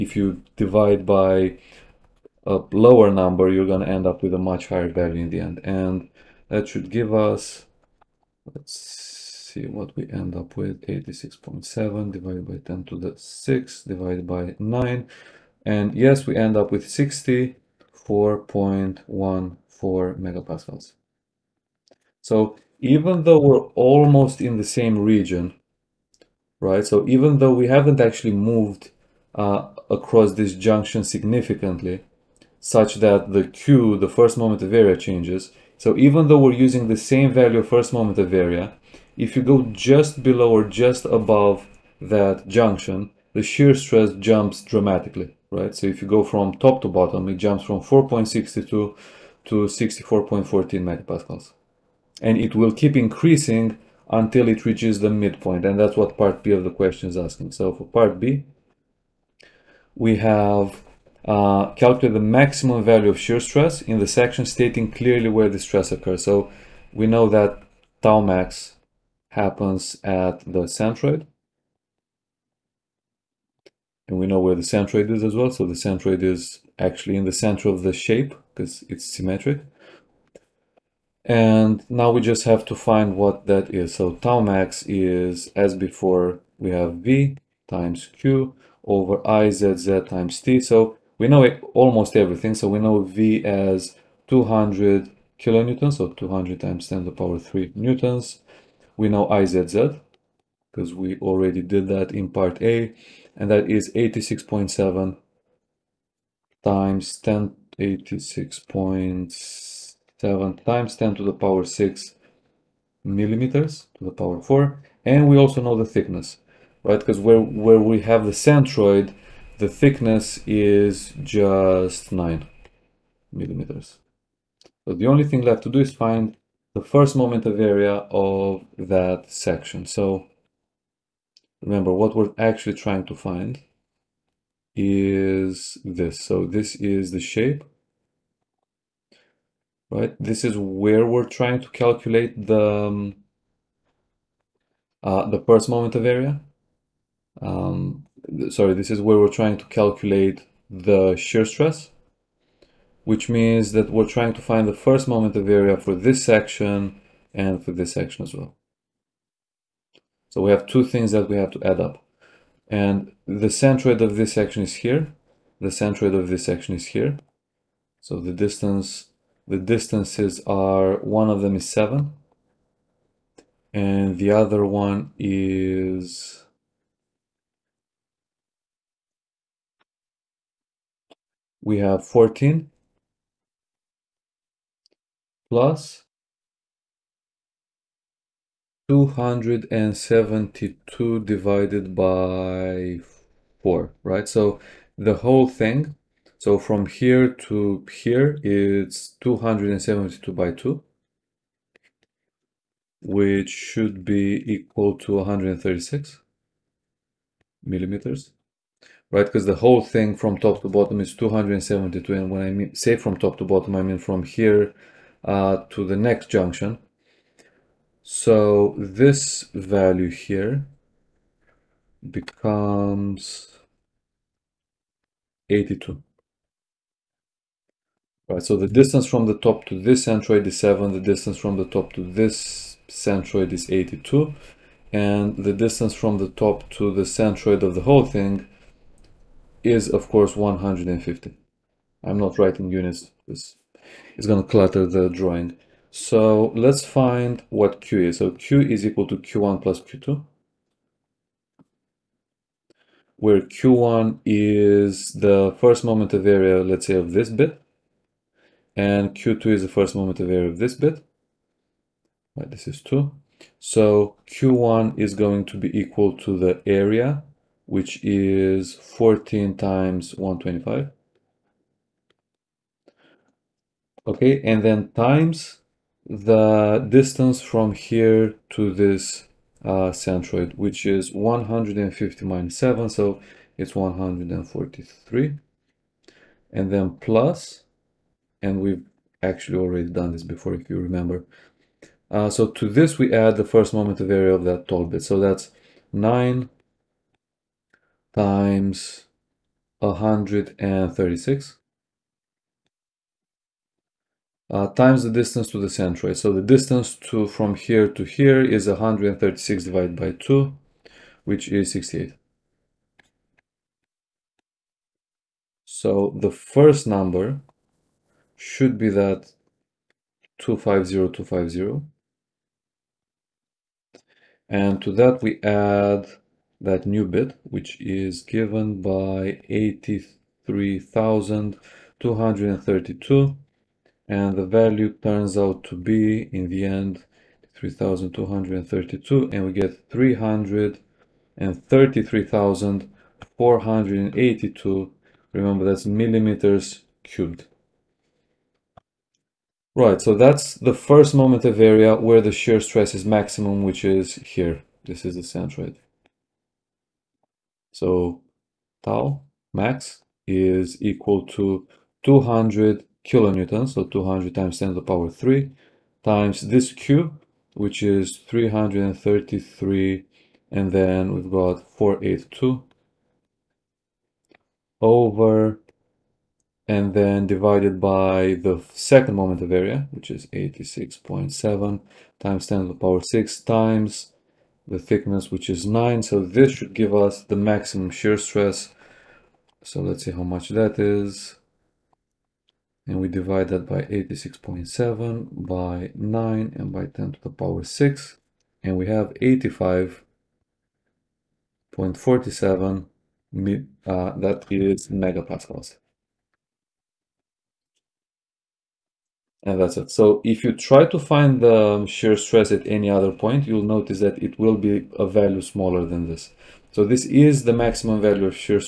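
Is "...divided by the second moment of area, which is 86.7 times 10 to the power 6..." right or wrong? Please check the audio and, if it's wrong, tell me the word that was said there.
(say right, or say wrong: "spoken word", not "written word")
right.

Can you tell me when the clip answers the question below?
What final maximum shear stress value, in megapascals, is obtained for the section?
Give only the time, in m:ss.
6:39.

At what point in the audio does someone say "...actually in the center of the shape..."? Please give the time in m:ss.
1:16.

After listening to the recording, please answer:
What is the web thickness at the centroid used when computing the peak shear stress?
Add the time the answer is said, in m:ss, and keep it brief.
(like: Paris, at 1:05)
9 millimeters, at 2:02.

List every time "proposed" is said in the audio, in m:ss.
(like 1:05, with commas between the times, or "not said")
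not said.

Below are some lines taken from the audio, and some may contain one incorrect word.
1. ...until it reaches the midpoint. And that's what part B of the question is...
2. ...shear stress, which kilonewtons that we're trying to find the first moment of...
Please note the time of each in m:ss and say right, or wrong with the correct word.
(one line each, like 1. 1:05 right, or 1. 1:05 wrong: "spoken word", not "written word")
1. 0:54 right
2. 2:31 wrong: "means", not "kilonewtons".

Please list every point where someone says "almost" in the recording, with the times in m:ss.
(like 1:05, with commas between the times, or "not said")
0:23, 1:31.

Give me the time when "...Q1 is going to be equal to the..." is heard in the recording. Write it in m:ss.
4:24.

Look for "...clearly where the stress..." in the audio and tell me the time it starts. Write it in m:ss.
1:04.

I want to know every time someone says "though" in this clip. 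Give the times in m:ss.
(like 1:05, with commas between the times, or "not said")
0:23, 0:27, 0:36.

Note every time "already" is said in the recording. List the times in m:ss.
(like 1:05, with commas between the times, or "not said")
1:41, 4:49.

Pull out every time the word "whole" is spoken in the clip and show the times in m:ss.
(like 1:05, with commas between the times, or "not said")
3:15, 3:29, 3:57.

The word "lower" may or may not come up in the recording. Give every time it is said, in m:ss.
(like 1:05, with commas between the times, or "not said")
0:02.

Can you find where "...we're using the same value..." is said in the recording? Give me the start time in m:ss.
0:36.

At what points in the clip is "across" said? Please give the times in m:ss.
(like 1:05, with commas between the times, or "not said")
0:29.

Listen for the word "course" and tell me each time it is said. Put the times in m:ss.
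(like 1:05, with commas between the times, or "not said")
4:00.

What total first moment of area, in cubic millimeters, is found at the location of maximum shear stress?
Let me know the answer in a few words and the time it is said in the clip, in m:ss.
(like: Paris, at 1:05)
333,482, at 5:39.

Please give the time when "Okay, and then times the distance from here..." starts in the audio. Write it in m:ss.
4:34.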